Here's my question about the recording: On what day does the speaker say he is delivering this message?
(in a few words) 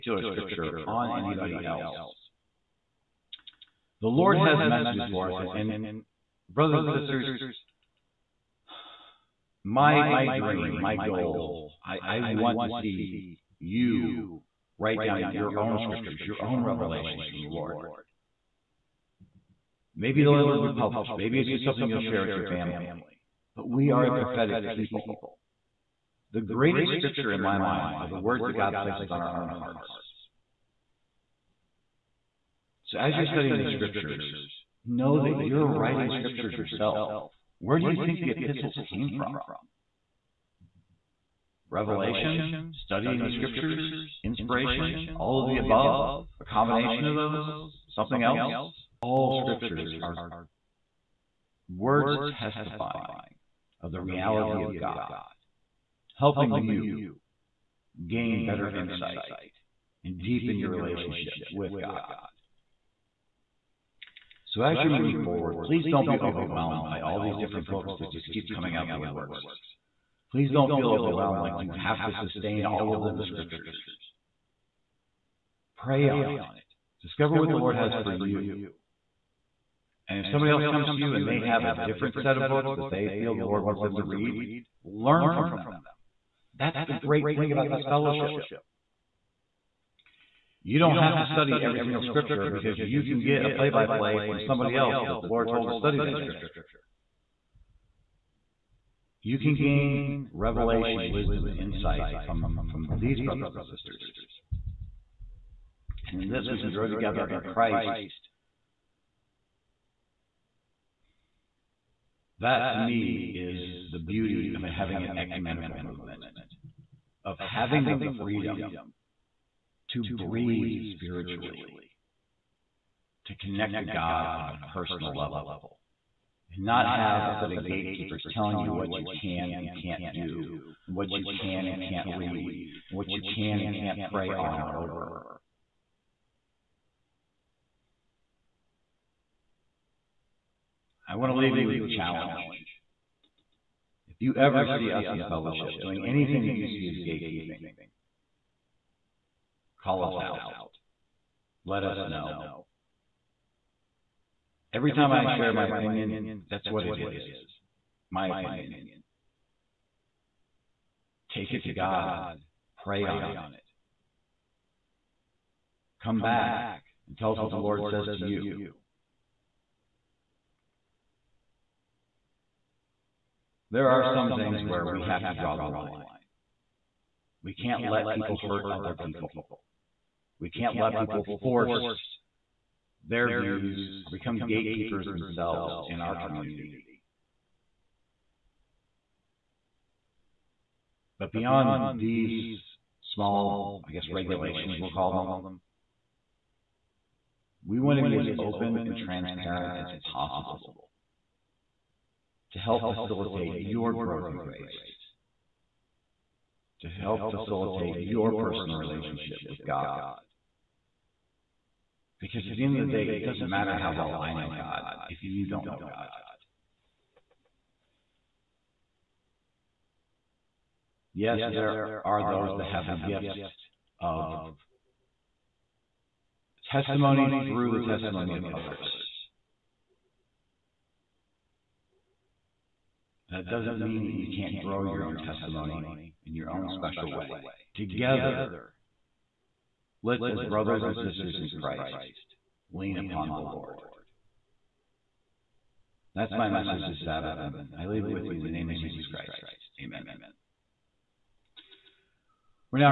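Sabbath.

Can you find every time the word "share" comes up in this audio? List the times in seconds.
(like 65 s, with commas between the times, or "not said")
22 s, 155 s.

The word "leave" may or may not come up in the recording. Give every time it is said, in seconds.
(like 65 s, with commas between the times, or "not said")
141 s, 247 s.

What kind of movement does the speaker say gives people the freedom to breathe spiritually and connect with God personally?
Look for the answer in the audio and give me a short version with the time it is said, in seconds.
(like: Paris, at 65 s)
Ecumenical movement, at 115 s.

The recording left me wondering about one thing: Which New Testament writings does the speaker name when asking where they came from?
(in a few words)
The epistles.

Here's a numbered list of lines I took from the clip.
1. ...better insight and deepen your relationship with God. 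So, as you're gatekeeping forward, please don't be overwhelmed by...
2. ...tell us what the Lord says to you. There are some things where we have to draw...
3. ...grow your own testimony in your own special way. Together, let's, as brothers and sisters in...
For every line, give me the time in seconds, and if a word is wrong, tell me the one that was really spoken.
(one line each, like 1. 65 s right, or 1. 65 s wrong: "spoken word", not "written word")
1. 58 s wrong: "moving", not "gatekeeping"
2. 167 s right
3. 234 s right.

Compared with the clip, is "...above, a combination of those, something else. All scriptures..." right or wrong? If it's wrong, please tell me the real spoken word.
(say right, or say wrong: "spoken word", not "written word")
right.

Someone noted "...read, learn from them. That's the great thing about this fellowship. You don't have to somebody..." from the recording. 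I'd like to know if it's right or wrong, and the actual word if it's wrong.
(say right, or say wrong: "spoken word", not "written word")
wrong: "study", not "somebody".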